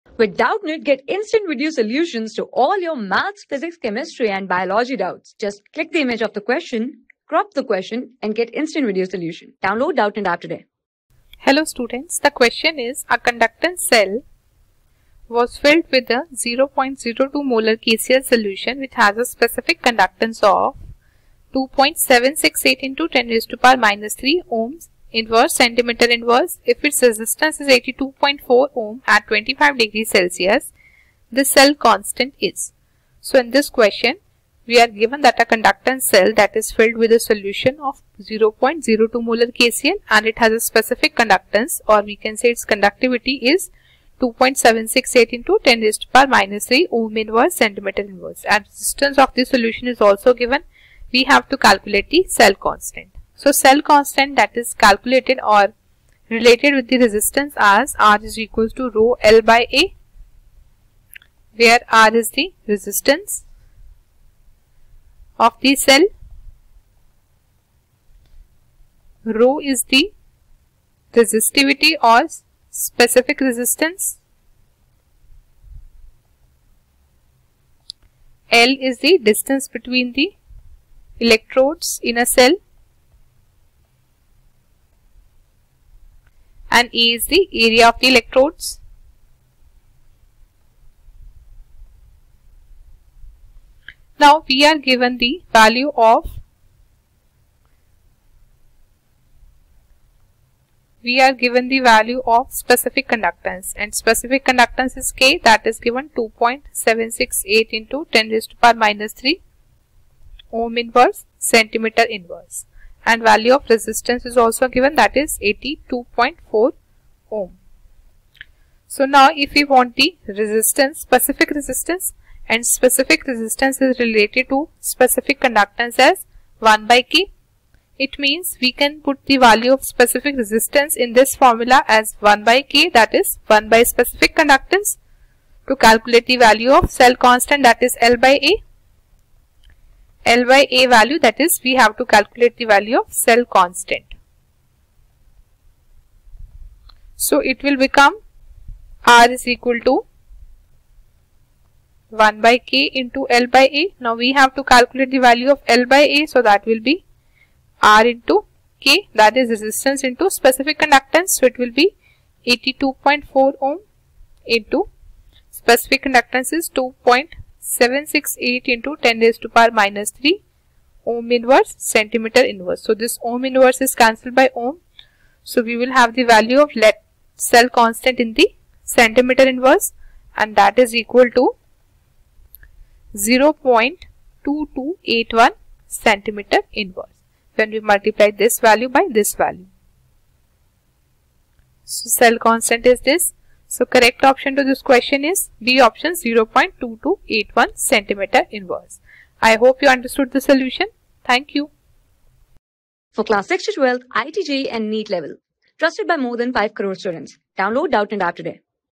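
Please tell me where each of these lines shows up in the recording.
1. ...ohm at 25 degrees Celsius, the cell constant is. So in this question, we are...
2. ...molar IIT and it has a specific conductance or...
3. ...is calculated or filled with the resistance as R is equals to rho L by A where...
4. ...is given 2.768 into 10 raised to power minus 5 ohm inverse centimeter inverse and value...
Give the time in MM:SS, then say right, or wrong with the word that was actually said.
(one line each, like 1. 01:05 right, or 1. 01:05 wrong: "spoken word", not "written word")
1. 00:28 right
2. 00:39 wrong: "KCl", not "IIT"
3. 00:54 wrong: "related", not "filled"
4. 01:45 wrong: "3", not "5".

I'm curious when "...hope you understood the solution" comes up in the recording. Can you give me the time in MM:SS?
03:19.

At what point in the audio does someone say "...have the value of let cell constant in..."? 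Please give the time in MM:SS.
02:55.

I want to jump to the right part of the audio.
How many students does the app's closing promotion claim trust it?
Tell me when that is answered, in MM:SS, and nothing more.
03:26.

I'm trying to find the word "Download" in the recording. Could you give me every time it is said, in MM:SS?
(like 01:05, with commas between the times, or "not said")
00:09, 03:27.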